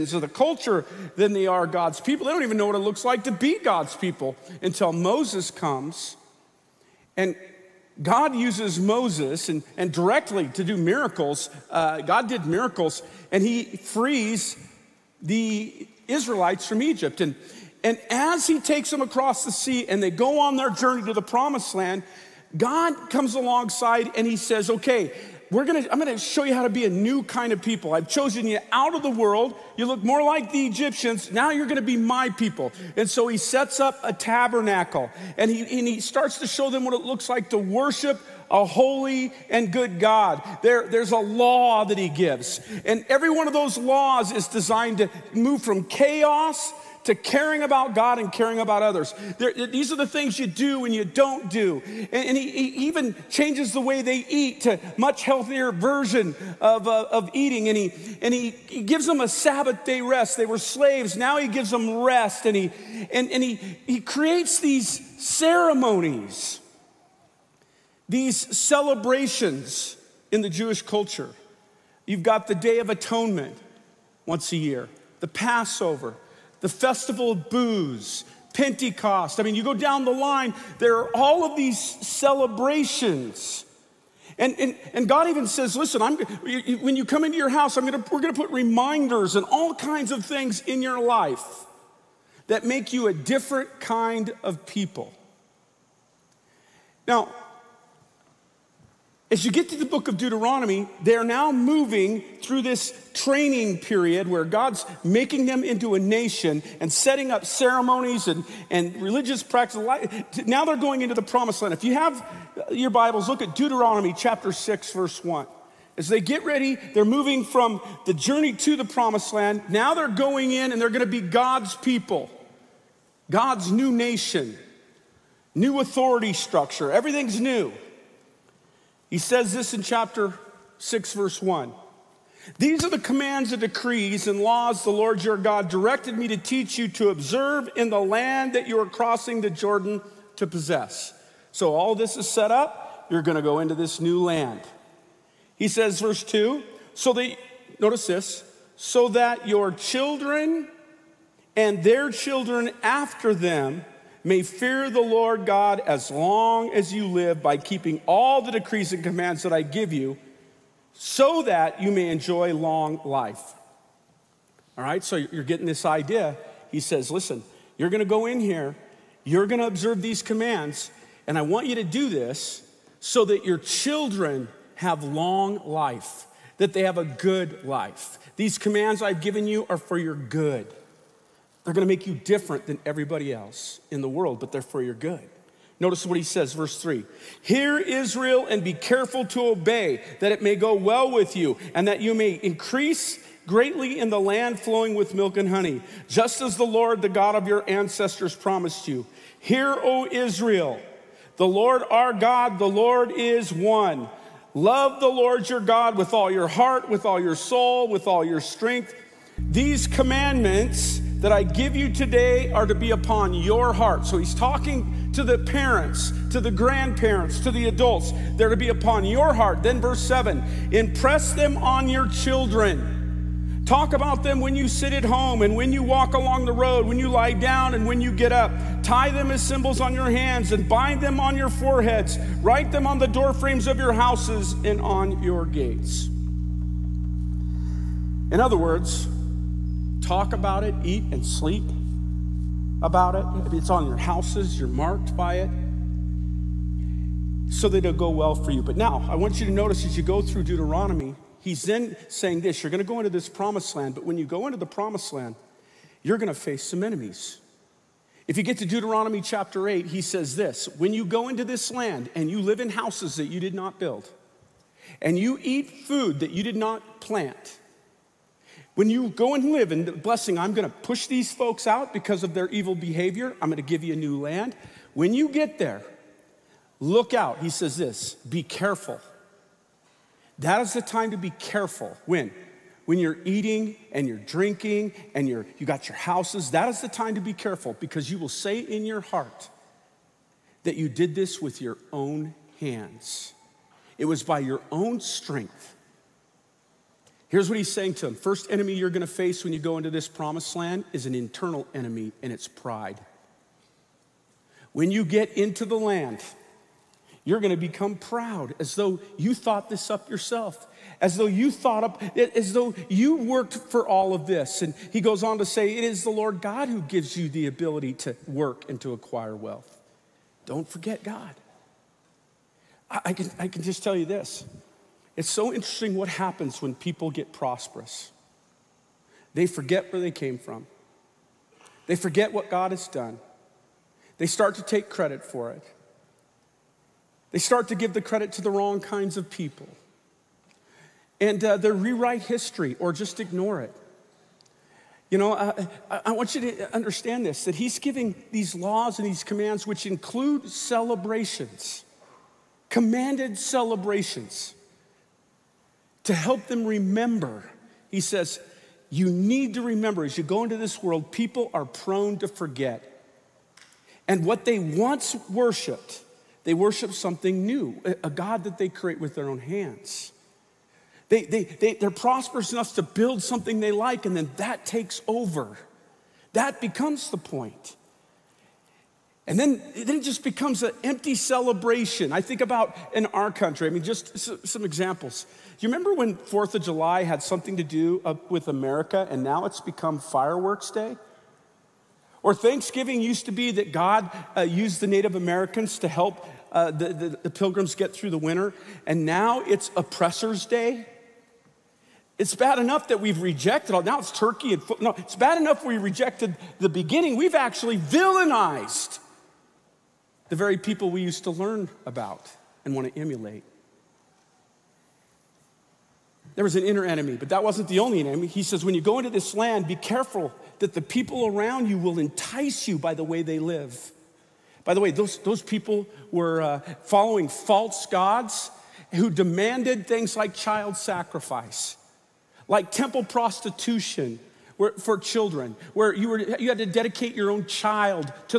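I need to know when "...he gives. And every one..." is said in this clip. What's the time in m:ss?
0:41.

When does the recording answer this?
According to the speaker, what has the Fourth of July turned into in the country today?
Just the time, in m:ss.
6:29.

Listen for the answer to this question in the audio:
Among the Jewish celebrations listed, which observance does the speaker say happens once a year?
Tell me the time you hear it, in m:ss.
1:12.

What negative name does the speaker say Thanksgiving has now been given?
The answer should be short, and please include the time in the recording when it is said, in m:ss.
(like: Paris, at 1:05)
Oppressor's Day, at 6:39.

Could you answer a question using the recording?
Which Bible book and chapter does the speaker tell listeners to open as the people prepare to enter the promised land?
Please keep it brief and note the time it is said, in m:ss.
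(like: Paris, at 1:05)
Deuteronomy 6, at 1:53.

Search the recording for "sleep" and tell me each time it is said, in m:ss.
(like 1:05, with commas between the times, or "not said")
4:01.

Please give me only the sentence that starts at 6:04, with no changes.
And what they once worshiped, they worship something new, a God that they create with their own hands.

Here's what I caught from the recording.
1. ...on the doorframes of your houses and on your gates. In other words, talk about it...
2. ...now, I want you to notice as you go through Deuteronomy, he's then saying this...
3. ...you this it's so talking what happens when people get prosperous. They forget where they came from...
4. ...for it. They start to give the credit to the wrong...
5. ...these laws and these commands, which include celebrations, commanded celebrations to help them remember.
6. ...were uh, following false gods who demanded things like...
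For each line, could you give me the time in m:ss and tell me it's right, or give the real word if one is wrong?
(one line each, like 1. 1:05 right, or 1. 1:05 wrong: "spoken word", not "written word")
1. 3:52 right
2. 4:08 right
3. 5:23 wrong: "interesting", not "talking"
4. 5:35 right
5. 5:48 right
6. 7:06 right.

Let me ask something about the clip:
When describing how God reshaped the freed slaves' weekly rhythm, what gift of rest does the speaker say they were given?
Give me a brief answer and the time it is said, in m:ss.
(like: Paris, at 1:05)
Sabbath day rest, at 0:59.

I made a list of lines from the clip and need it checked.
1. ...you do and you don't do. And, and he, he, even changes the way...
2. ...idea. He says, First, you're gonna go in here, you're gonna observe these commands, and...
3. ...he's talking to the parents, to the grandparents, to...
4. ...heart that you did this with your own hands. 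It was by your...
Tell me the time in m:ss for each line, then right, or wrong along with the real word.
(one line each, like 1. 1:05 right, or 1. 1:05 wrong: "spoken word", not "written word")
1. 0:50 right
2. 2:45 wrong: "Listen", not "First"
3. 3:34 right
4. 4:49 right.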